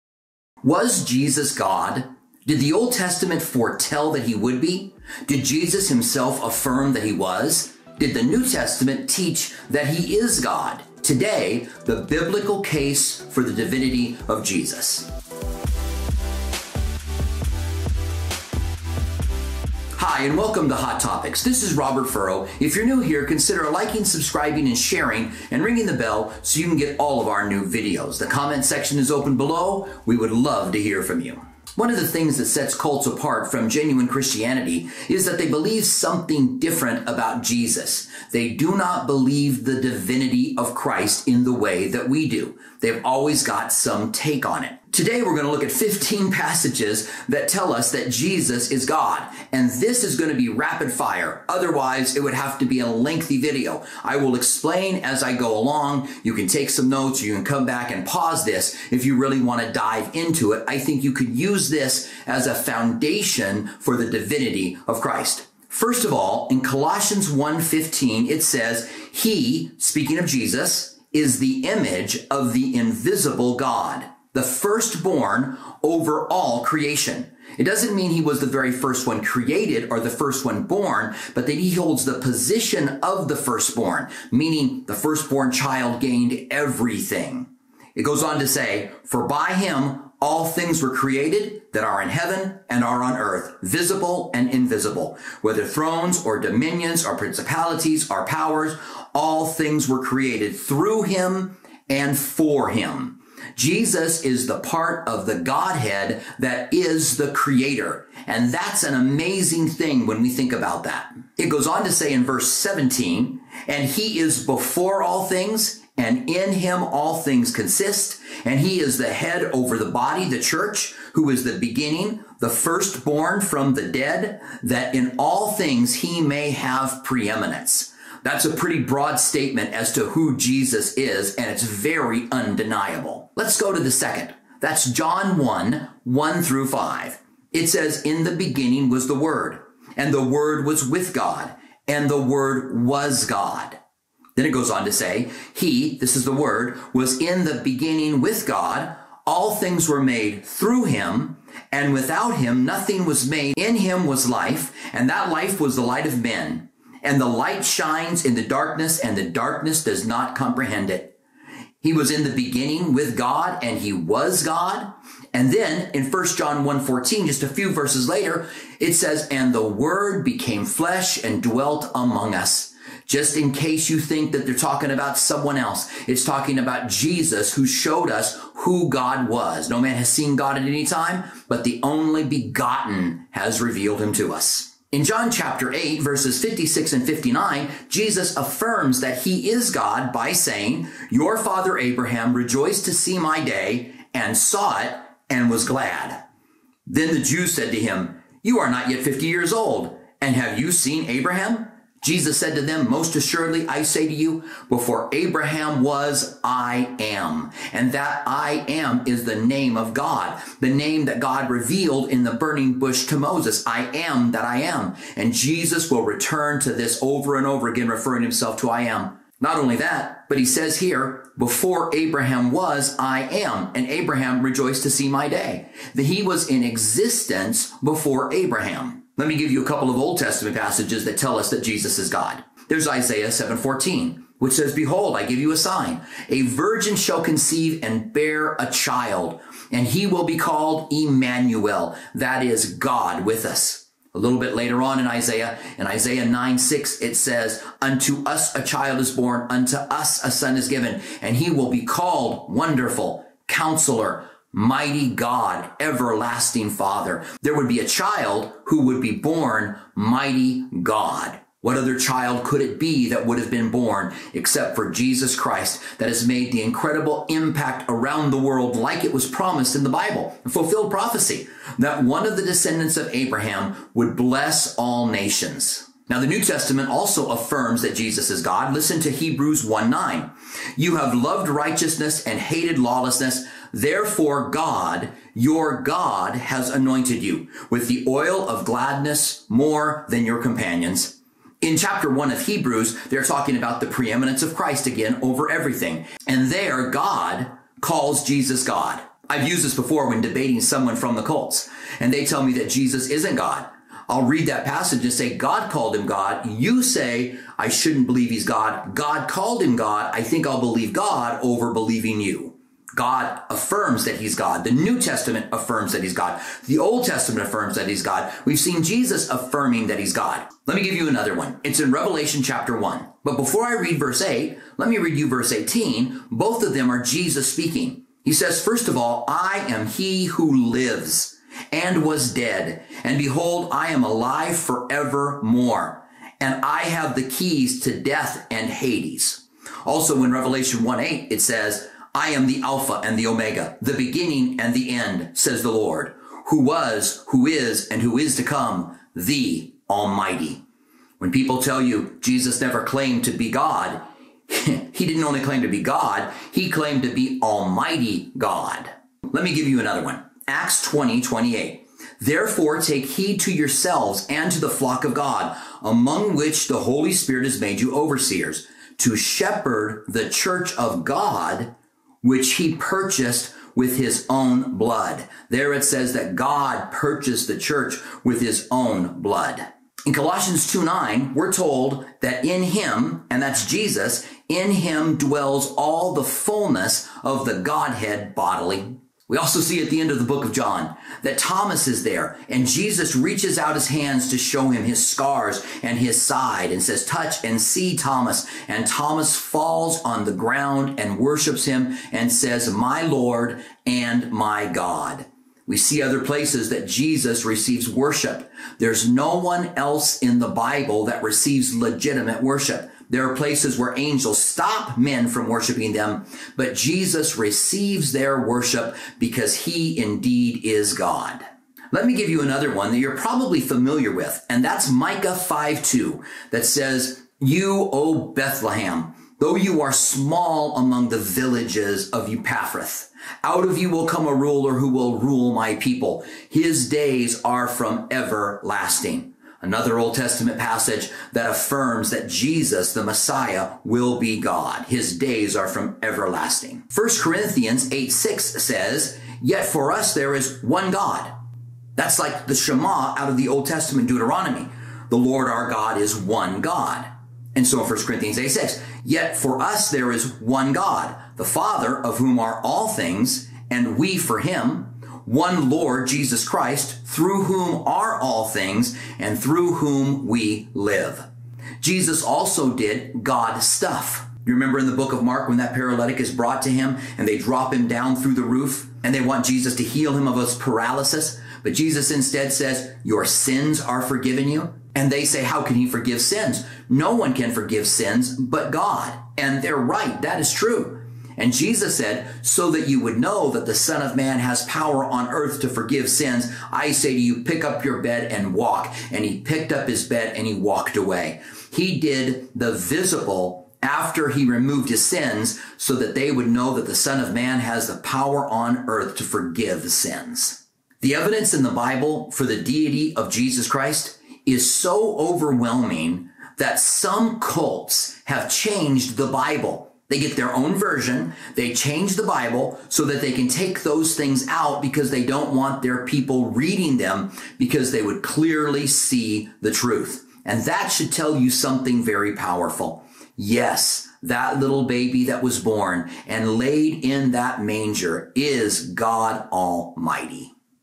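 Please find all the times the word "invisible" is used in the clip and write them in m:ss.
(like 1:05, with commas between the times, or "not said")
1:12, 1:34.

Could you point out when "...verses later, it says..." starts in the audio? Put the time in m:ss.
2:47.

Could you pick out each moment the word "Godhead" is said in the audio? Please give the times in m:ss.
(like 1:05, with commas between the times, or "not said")
1:45, 6:27.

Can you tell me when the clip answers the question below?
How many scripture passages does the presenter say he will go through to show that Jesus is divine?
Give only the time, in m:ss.
0:45.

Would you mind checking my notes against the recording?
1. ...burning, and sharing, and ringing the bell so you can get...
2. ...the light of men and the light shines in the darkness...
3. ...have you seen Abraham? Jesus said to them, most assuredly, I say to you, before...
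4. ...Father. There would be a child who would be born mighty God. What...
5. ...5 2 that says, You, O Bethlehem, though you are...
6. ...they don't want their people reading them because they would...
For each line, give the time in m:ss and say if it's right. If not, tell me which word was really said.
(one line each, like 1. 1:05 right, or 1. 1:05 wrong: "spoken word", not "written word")
1. 0:24 wrong: "subscribing", not "burning"
2. 2:35 right
3. 3:20 right
4. 4:16 right
5. 7:05 right
6. 8:45 right.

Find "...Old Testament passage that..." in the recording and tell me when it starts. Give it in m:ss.
7:19.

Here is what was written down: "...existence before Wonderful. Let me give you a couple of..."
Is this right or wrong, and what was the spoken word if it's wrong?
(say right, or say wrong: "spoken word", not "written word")
wrong: "Abraham", not "Wonderful".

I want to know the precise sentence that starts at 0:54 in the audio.
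I will explain as I go along.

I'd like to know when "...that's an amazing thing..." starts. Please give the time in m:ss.
1:48.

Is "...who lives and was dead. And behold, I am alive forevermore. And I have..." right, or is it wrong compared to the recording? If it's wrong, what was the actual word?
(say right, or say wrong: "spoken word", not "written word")
right.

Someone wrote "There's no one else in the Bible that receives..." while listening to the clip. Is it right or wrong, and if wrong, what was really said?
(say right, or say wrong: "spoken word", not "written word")
right.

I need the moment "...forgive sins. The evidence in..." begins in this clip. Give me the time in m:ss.
8:29.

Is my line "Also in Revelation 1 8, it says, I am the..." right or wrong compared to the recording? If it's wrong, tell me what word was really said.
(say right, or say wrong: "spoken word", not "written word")
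right.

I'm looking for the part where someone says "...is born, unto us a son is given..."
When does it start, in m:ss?
4:08.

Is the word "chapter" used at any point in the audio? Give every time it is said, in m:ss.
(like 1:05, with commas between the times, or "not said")
3:05, 4:51, 5:22.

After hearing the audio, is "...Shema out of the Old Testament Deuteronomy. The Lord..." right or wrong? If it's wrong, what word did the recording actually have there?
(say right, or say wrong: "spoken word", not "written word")
right.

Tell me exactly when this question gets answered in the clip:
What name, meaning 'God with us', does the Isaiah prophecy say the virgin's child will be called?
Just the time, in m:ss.
4:00.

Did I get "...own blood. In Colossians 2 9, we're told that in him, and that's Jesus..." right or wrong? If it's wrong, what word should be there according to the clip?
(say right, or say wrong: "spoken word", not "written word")
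right.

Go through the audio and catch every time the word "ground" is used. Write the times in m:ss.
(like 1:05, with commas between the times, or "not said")
6:40.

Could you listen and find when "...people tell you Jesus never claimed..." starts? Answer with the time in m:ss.
5:51.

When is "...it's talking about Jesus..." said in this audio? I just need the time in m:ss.
2:56.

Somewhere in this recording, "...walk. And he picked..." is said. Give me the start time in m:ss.
8:18.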